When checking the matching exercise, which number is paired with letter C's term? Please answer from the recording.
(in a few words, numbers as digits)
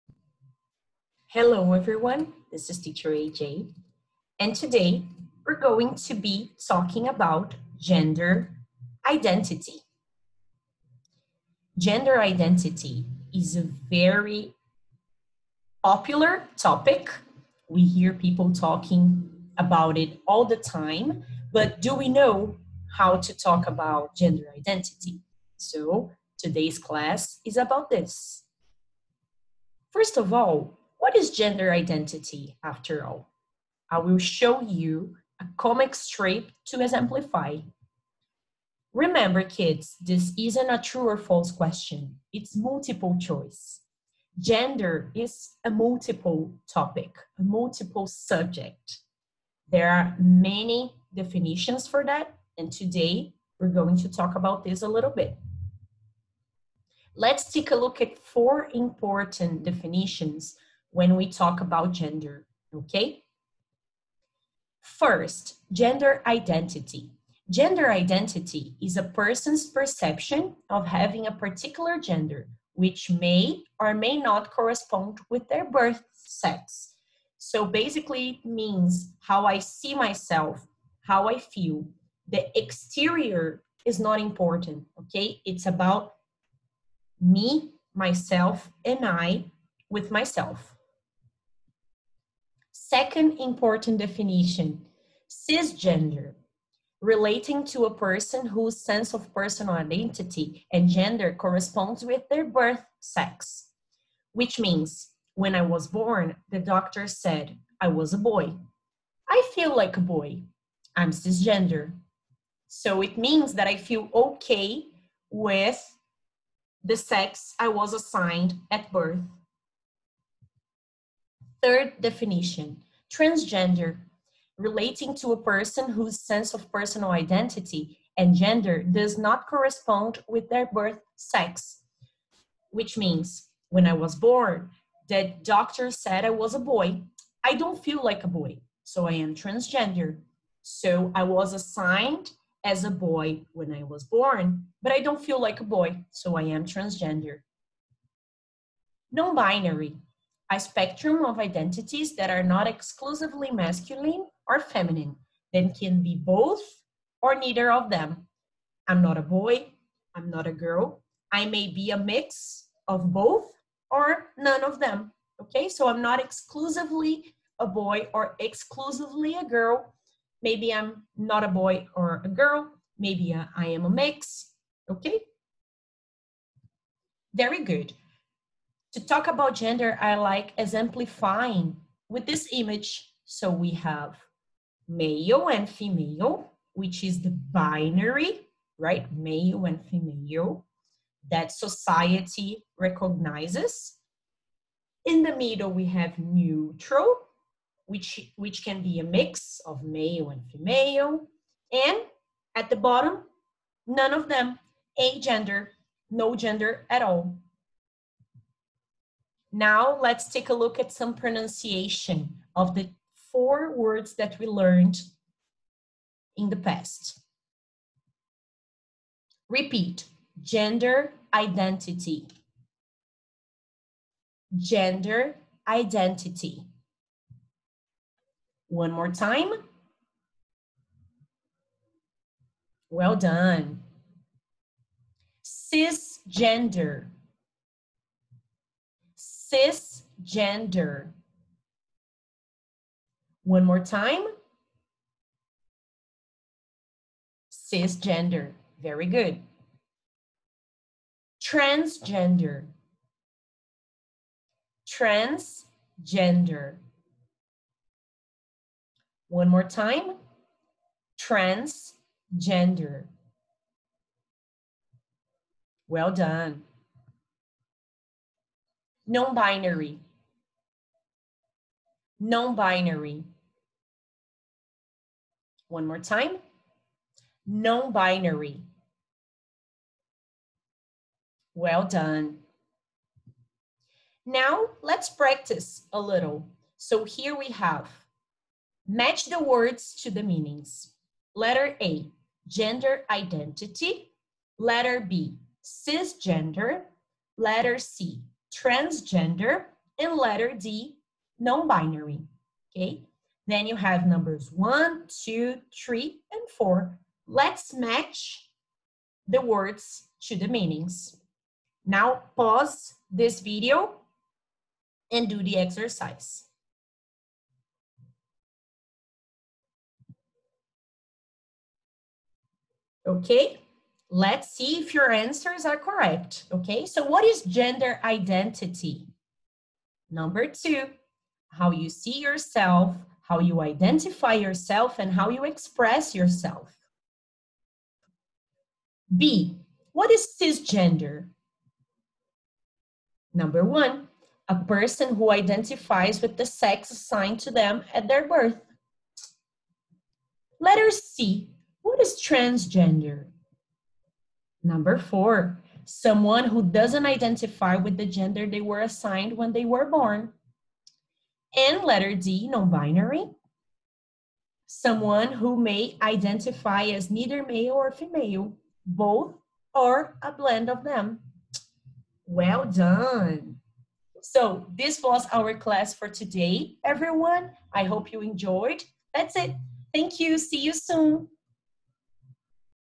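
4.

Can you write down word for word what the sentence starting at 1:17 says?
So basically, it means how I see myself, how I feel.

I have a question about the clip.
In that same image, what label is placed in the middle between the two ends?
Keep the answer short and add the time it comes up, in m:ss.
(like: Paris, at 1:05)
Neutral, at 3:16.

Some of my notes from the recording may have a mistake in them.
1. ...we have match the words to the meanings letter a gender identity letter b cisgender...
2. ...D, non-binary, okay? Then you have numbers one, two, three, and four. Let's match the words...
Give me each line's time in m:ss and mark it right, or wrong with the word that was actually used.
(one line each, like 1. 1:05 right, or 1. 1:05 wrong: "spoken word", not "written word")
1. 4:47 right
2. 5:00 right.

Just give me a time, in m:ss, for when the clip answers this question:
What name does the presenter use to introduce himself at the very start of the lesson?
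0:02.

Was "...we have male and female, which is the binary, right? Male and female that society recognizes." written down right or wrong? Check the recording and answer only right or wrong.
right.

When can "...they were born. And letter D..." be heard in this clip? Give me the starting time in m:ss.
5:59.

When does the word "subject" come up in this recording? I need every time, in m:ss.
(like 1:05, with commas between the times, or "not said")
0:48.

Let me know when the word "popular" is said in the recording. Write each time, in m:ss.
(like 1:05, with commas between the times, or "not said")
0:15.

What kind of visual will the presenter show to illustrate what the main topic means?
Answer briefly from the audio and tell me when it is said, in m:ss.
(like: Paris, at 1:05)
A comic strip, at 0:35.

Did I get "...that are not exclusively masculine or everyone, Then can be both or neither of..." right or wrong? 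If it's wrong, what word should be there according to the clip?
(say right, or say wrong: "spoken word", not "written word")
wrong: "feminine", not "everyone".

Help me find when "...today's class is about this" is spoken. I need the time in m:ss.
0:26.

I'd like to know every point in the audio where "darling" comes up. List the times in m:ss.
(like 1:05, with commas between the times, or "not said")
not said.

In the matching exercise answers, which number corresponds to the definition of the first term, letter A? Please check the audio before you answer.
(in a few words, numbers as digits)
2.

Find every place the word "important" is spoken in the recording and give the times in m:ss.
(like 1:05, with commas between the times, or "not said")
0:58, 1:24, 1:33.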